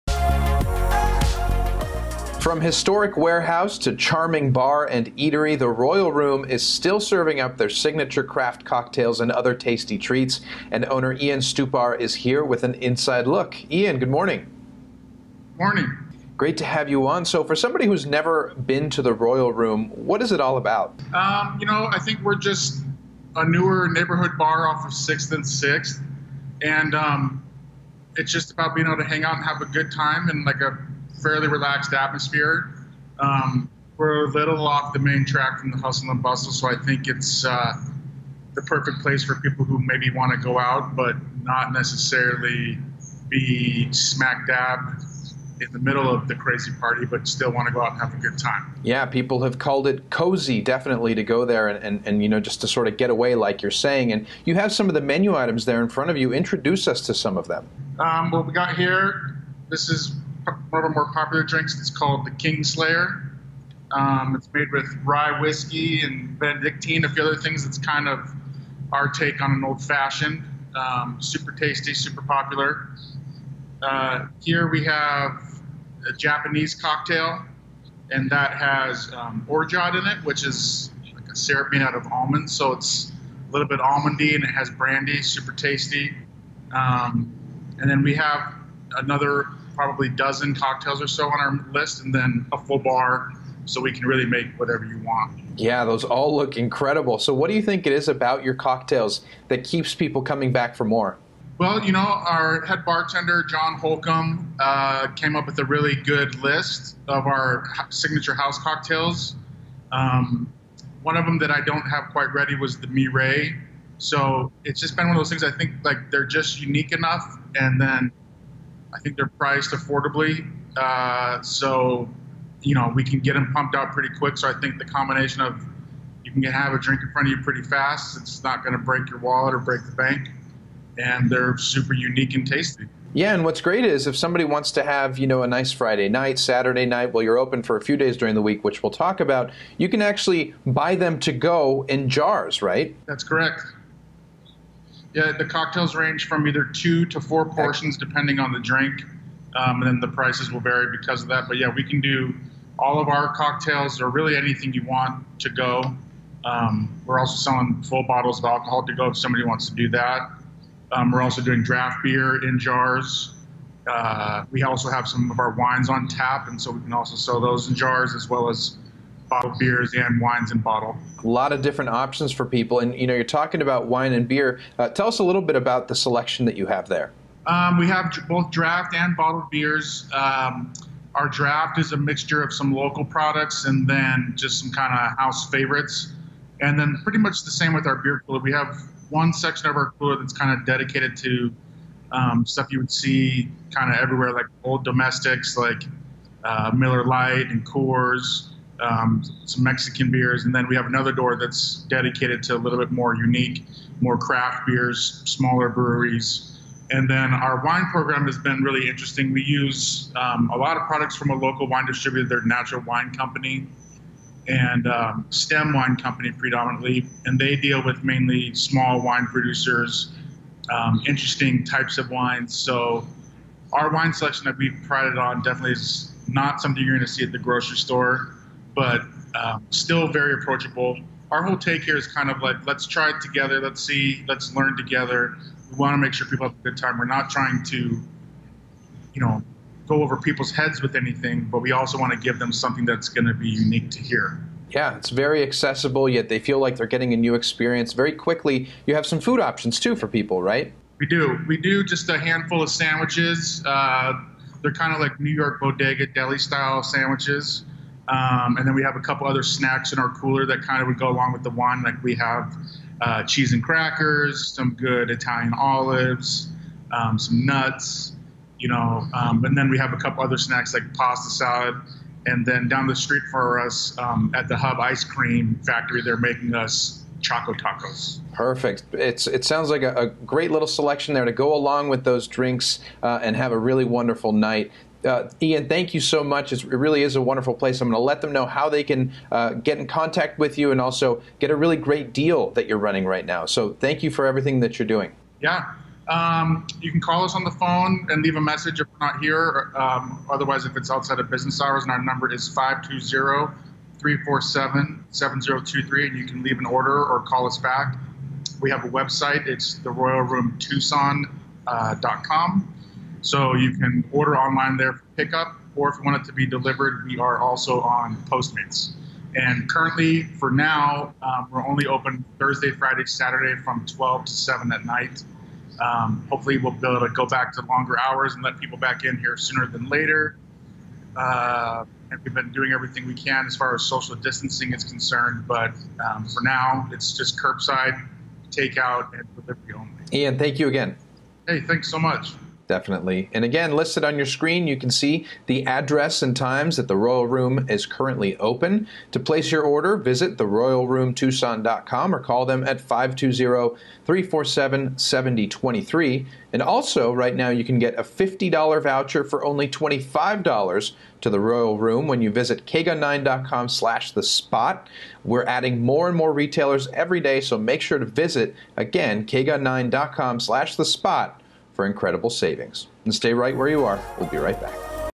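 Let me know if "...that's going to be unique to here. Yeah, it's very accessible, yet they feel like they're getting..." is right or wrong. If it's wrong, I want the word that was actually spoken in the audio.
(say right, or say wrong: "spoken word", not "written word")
right.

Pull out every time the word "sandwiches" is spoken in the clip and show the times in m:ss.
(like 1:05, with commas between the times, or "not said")
4:12, 4:16.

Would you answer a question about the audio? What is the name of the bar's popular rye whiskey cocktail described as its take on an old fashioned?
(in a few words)
Kingslayer.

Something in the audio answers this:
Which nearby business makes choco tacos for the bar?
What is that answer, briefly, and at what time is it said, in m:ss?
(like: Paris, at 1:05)
Hub Ice Cream Factory, at 4:34.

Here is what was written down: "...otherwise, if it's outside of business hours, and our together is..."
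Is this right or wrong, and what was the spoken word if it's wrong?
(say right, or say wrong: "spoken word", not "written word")
wrong: "number", not "together".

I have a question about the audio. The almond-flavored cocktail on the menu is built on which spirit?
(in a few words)
brandy.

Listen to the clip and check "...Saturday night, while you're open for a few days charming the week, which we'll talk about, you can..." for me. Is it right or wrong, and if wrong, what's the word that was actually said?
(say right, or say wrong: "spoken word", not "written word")
wrong: "during", not "charming".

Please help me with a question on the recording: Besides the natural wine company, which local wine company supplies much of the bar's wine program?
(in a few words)
Stem Wine Company.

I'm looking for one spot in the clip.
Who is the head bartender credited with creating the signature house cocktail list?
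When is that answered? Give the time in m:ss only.
1:43.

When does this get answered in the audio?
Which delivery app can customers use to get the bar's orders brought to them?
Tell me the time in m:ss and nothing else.
5:18.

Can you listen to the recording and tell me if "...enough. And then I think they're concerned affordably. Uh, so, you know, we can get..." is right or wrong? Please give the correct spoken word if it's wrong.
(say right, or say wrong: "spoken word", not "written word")
wrong: "priced", not "concerned".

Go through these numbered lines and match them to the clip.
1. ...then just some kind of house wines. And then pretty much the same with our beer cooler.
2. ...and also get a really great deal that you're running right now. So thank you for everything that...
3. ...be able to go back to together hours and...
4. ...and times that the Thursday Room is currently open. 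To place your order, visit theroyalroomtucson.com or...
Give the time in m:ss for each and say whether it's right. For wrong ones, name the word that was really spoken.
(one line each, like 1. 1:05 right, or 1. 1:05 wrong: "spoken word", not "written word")
1. 3:03 wrong: "favorites", not "wines"
2. 4:50 right
3. 5:26 wrong: "longer", not "together"
4. 5:46 wrong: "Royal", not "Thursday".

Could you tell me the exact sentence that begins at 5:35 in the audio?
But um, for now, it's just curbside, takeout, and delivery only.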